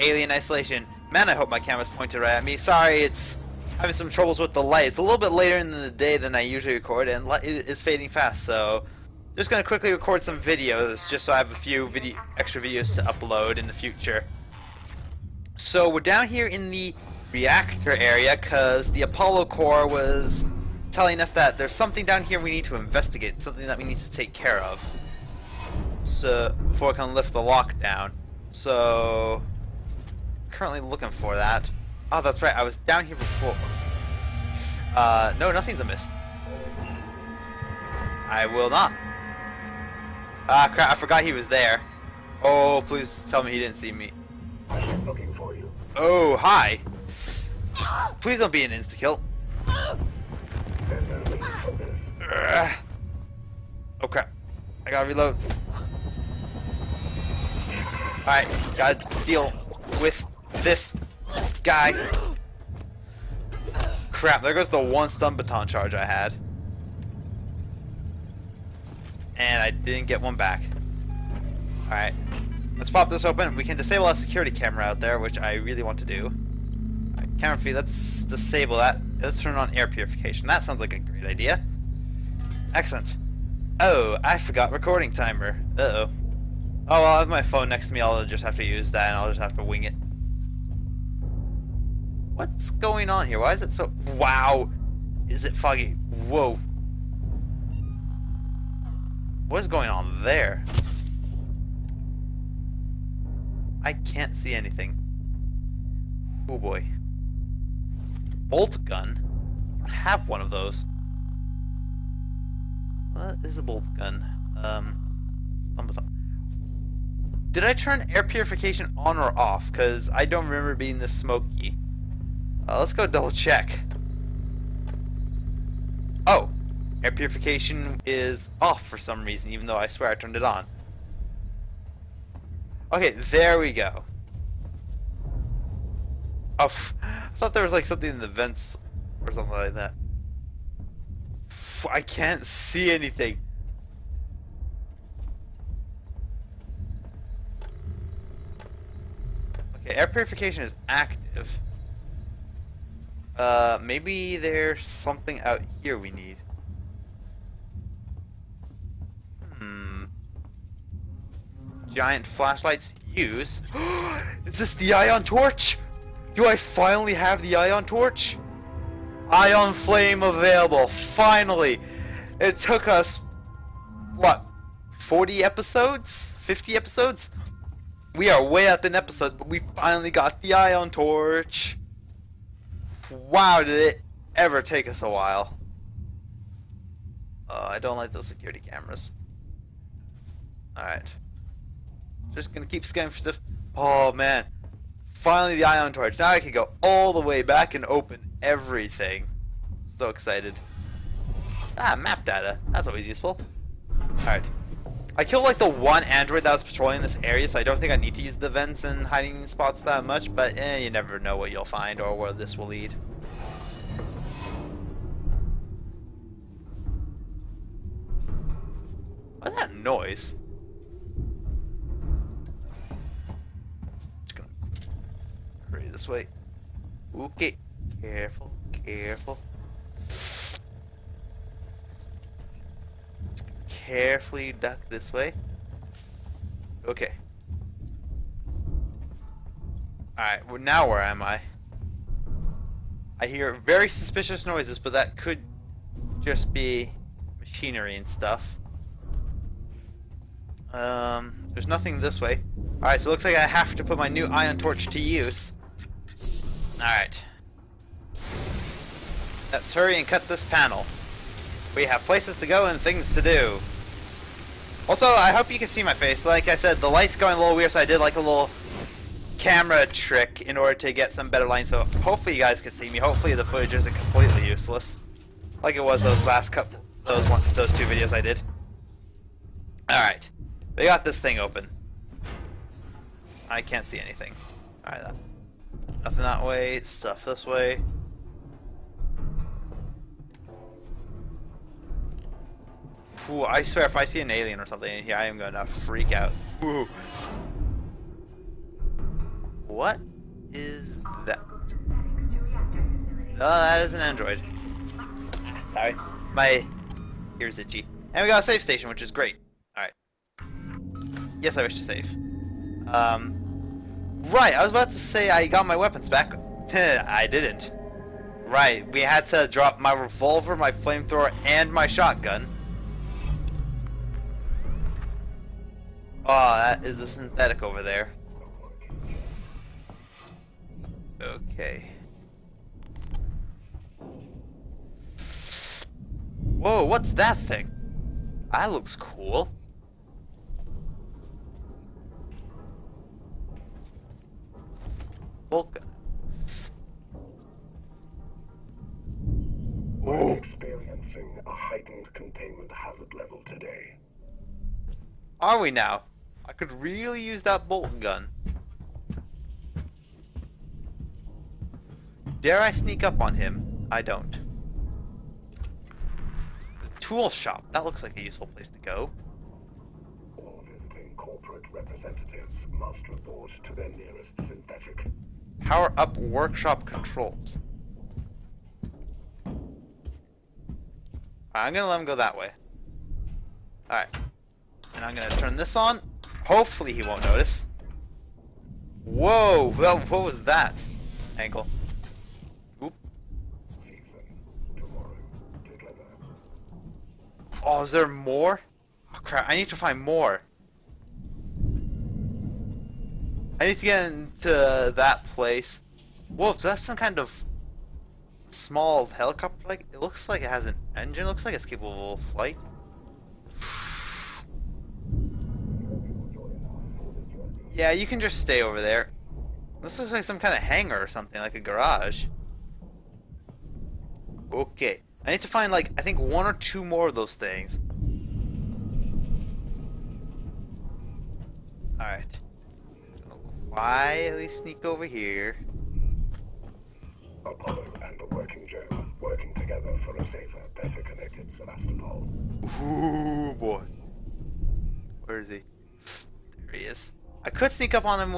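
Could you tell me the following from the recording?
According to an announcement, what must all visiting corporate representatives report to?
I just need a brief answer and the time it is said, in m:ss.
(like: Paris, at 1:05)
Their nearest synthetic, at 6:13.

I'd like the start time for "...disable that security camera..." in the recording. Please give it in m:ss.
1:13.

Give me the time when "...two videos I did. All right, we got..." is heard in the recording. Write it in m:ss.
4:37.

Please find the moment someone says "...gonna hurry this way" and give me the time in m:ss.
3:44.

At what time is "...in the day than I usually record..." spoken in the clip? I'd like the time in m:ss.
0:05.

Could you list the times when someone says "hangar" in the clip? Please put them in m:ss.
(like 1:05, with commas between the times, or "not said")
7:00.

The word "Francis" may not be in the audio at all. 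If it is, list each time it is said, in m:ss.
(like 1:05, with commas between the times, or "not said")
not said.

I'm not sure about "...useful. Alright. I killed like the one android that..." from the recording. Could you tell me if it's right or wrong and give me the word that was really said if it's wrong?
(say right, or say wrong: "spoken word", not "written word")
right.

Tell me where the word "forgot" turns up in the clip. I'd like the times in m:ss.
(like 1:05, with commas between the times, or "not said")
0:40, 1:24.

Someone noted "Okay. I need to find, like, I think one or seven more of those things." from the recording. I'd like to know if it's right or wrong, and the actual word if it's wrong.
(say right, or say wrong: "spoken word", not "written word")
wrong: "two", not "seven".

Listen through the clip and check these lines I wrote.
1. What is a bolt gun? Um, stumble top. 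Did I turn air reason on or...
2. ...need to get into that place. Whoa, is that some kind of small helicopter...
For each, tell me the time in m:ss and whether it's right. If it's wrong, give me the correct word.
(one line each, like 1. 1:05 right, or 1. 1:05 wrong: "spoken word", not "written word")
1. 1:53 wrong: "purification", not "reason"
2. 6:43 right.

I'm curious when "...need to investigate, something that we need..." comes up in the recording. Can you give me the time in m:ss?
0:22.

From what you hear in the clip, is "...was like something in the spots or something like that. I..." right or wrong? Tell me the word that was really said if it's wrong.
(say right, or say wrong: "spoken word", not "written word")
wrong: "vents", not "spots".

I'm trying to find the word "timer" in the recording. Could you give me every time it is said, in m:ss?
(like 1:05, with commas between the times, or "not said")
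1:25.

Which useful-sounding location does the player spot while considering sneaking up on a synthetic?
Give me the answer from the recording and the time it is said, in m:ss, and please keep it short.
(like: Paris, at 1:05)
The tool shop, at 6:06.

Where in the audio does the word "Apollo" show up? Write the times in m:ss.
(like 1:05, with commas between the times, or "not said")
0:19, 7:17.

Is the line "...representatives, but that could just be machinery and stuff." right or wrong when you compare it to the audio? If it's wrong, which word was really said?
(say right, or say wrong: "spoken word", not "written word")
wrong: "noises", not "representatives".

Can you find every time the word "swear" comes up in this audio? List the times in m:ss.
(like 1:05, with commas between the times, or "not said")
2:09, 4:53.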